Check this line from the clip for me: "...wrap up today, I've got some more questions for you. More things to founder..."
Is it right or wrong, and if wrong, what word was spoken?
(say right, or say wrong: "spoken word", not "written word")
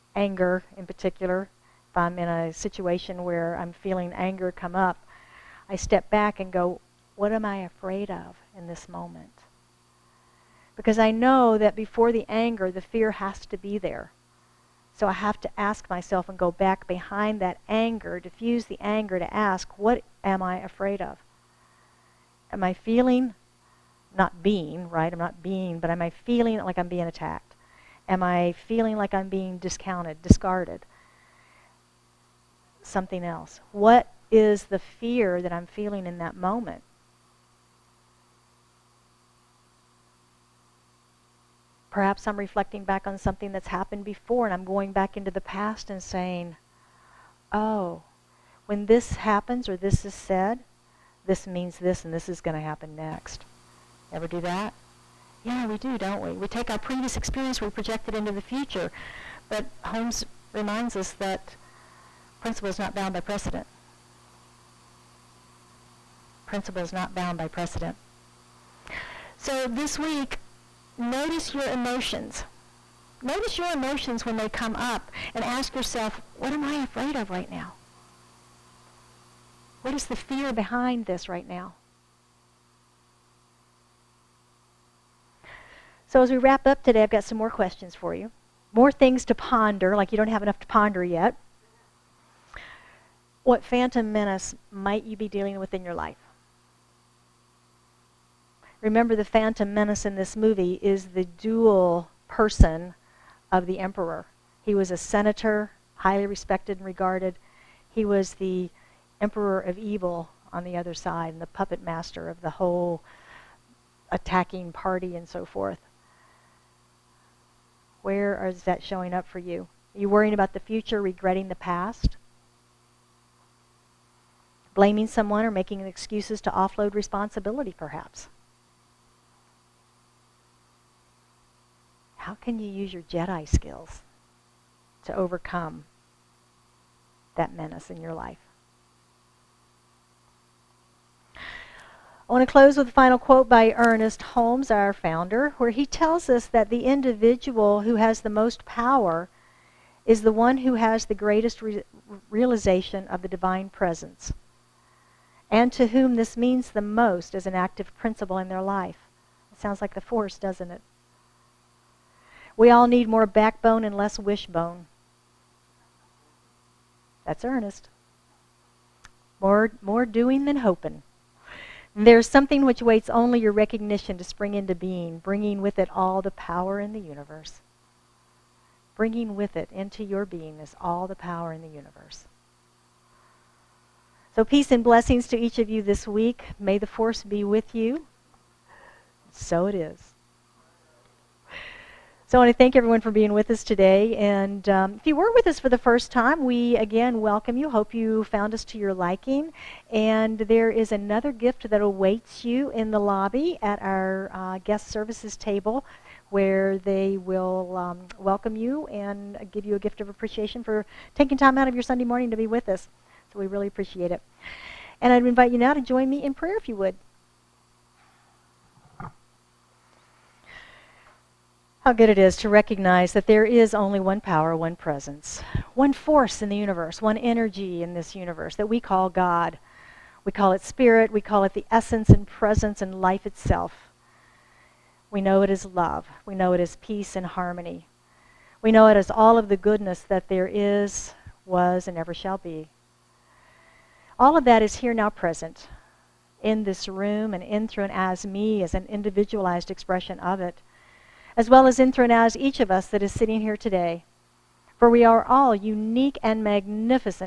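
wrong: "ponder", not "founder".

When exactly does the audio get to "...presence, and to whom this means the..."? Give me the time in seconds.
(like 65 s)
153 s.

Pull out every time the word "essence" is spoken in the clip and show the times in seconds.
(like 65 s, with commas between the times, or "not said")
231 s.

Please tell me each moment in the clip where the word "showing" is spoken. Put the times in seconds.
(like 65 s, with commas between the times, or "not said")
118 s.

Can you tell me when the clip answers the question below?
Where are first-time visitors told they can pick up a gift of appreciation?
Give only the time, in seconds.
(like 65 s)
204 s.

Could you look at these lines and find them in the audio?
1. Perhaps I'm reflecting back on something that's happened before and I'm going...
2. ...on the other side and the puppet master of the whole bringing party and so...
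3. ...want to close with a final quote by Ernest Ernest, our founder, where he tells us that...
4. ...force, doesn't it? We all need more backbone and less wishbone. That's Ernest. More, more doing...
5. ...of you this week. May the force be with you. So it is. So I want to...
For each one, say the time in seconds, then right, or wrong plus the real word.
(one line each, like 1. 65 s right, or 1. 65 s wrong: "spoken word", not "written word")
1. 41 s right
2. 110 s wrong: "attacking", not "bringing"
3. 142 s wrong: "Holmes", not "Ernest"
4. 160 s right
5. 185 s right.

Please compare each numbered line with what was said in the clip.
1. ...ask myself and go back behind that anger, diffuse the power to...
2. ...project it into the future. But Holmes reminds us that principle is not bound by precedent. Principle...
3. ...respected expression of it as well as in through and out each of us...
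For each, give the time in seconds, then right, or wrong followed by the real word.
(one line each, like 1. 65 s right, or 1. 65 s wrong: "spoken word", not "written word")
1. 15 s wrong: "anger", not "power"
2. 57 s right
3. 248 s wrong: "individualized", not "respected".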